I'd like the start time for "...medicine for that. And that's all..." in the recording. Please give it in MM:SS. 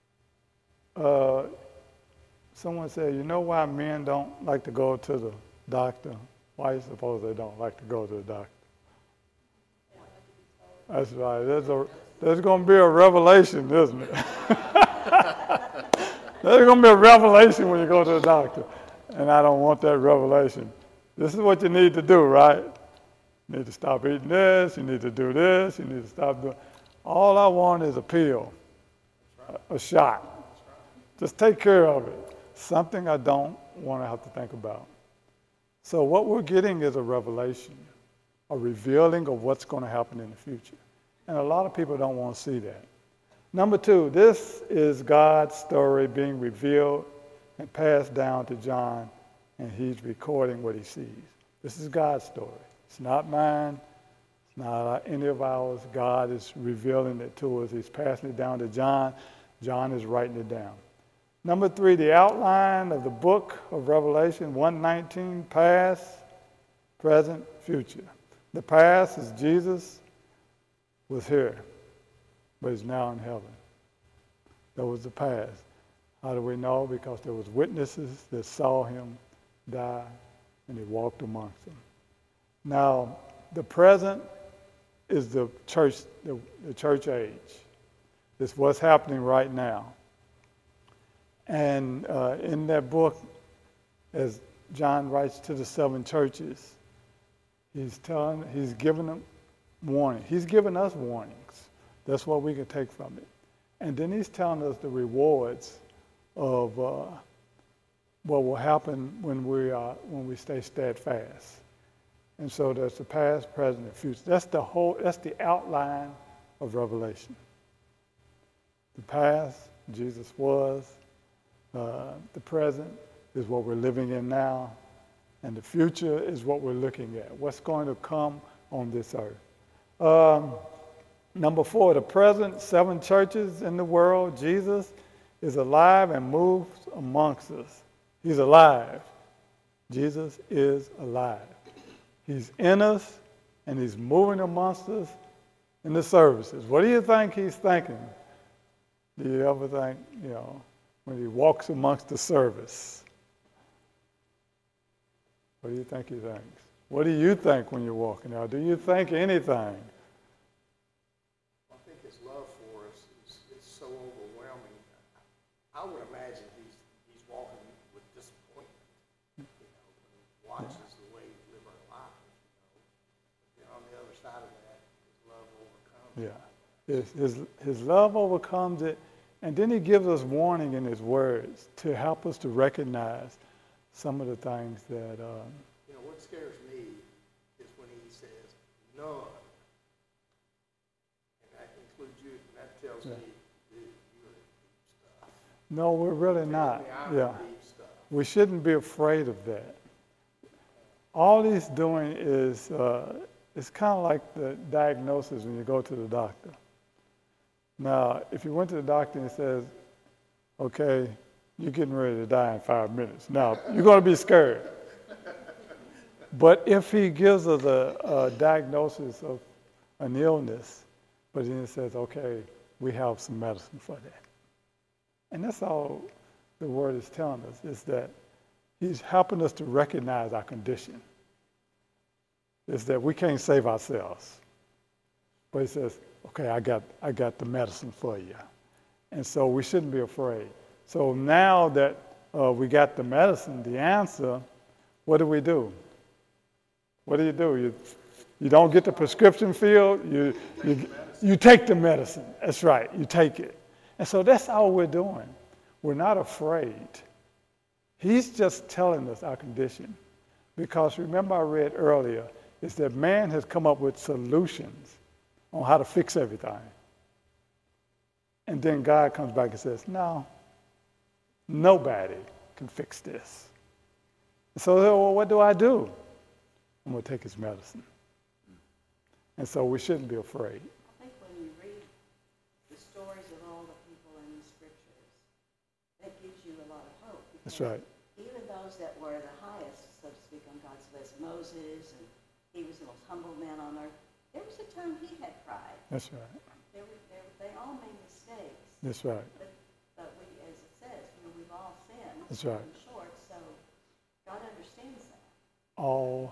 03:43.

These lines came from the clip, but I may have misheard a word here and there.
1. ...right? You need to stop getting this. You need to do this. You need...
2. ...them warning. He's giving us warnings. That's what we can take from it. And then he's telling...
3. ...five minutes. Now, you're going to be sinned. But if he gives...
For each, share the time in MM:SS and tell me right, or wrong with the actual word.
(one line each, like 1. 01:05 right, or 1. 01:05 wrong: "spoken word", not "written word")
1. 00:22 wrong: "eating", not "getting"
2. 01:39 right
3. 03:32 wrong: "scared", not "sinned".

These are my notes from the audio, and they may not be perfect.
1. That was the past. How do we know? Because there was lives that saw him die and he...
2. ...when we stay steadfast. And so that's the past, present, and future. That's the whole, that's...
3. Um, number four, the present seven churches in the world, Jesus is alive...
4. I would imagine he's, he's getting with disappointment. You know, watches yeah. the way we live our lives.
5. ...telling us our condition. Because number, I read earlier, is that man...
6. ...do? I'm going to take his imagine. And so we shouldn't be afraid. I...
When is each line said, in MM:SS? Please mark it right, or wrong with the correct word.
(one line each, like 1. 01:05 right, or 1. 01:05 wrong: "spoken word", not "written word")
1. 01:14 wrong: "witnesses", not "lives"
2. 01:50 right
3. 02:10 right
4. 02:45 wrong: "walking", not "getting"
5. 04:18 wrong: "remember", not "number"
6. 04:35 wrong: "medicine", not "imagine".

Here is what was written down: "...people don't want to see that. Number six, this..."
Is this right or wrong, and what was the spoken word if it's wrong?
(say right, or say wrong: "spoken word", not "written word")
wrong: "two", not "six".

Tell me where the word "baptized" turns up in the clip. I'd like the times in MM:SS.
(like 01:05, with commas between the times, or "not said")
not said.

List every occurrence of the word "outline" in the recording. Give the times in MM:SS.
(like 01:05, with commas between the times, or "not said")
01:02, 01:55.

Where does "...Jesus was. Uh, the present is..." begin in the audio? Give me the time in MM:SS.
01:59.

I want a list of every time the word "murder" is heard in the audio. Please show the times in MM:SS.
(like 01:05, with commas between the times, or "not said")
not said.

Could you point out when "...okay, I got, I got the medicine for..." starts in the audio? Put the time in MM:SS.
03:56.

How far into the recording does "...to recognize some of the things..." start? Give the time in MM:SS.
03:02.